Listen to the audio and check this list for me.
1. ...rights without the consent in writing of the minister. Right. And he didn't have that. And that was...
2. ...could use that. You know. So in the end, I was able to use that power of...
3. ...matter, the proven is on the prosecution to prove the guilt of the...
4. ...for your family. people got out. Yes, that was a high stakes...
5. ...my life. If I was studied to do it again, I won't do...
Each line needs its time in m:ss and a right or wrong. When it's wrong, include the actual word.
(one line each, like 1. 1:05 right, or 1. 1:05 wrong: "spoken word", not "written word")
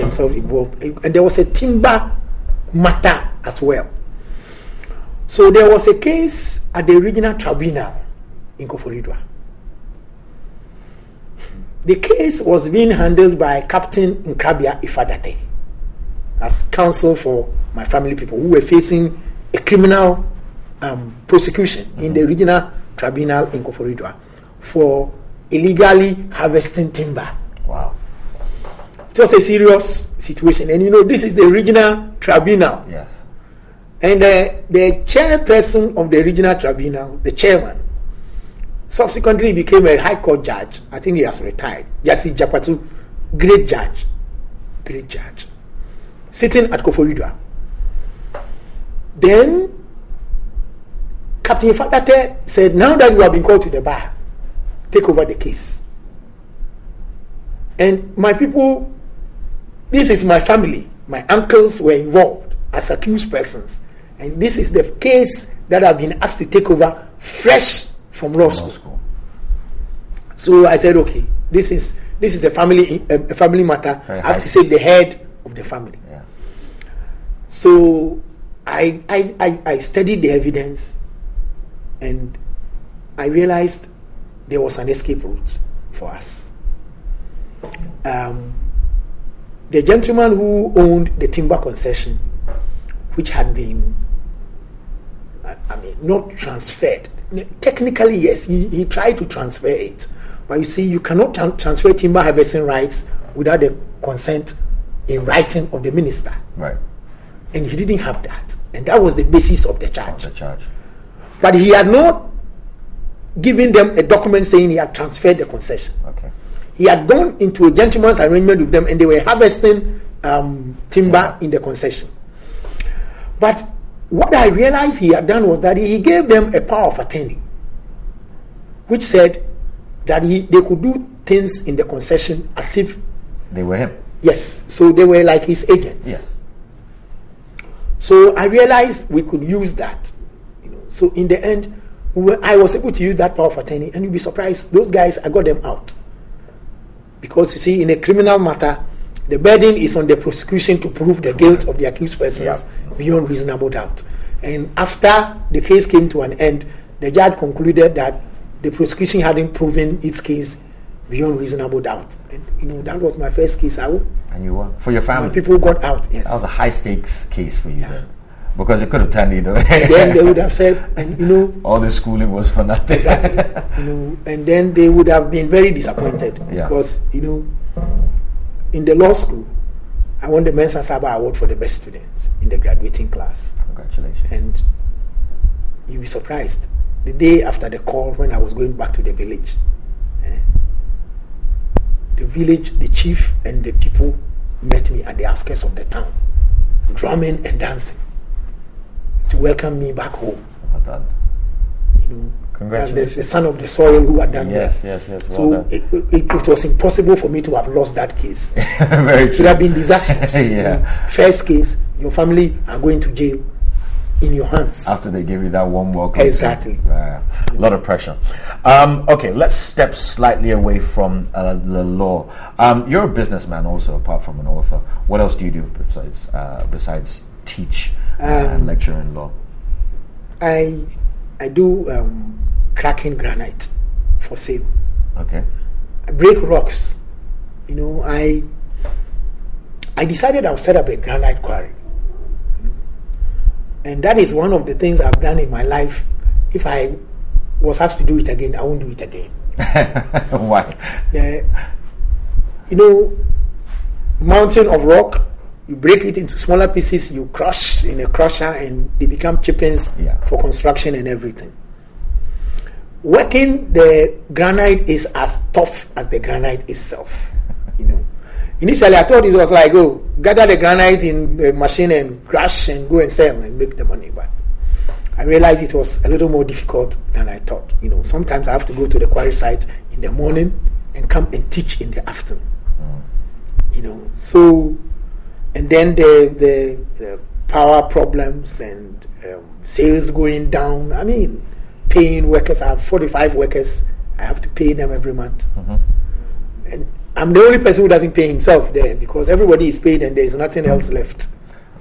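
1. 1:42 right
2. 2:19 right
3. 2:28 wrong: "burden", not "proven"
4. 2:44 right
5. 4:05 wrong: "asked", not "studied".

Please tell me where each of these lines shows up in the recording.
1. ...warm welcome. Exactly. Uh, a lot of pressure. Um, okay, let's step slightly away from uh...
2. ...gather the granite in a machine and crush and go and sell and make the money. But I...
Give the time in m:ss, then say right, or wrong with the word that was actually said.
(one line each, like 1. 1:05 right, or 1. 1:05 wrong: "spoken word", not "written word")
1. 3:35 right
2. 4:30 right.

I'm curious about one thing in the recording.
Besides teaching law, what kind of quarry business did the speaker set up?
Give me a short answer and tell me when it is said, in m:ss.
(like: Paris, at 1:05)
Granite quarry, at 4:00.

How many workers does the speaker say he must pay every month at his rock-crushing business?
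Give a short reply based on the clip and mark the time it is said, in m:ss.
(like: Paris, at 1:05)
45, at 4:52.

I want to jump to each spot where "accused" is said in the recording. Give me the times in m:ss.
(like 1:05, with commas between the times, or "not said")
1:02, 2:31.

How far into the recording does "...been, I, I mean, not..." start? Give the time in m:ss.
1:33.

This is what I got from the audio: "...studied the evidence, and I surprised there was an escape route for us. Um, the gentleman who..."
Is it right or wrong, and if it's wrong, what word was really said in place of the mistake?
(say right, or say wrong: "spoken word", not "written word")
wrong: "realized", not "surprised".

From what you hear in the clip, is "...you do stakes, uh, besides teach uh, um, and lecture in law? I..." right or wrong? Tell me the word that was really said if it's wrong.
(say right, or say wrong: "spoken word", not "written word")
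wrong: "besides", not "stakes".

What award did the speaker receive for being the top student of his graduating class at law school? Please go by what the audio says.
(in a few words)
Mensah Sarbah Award.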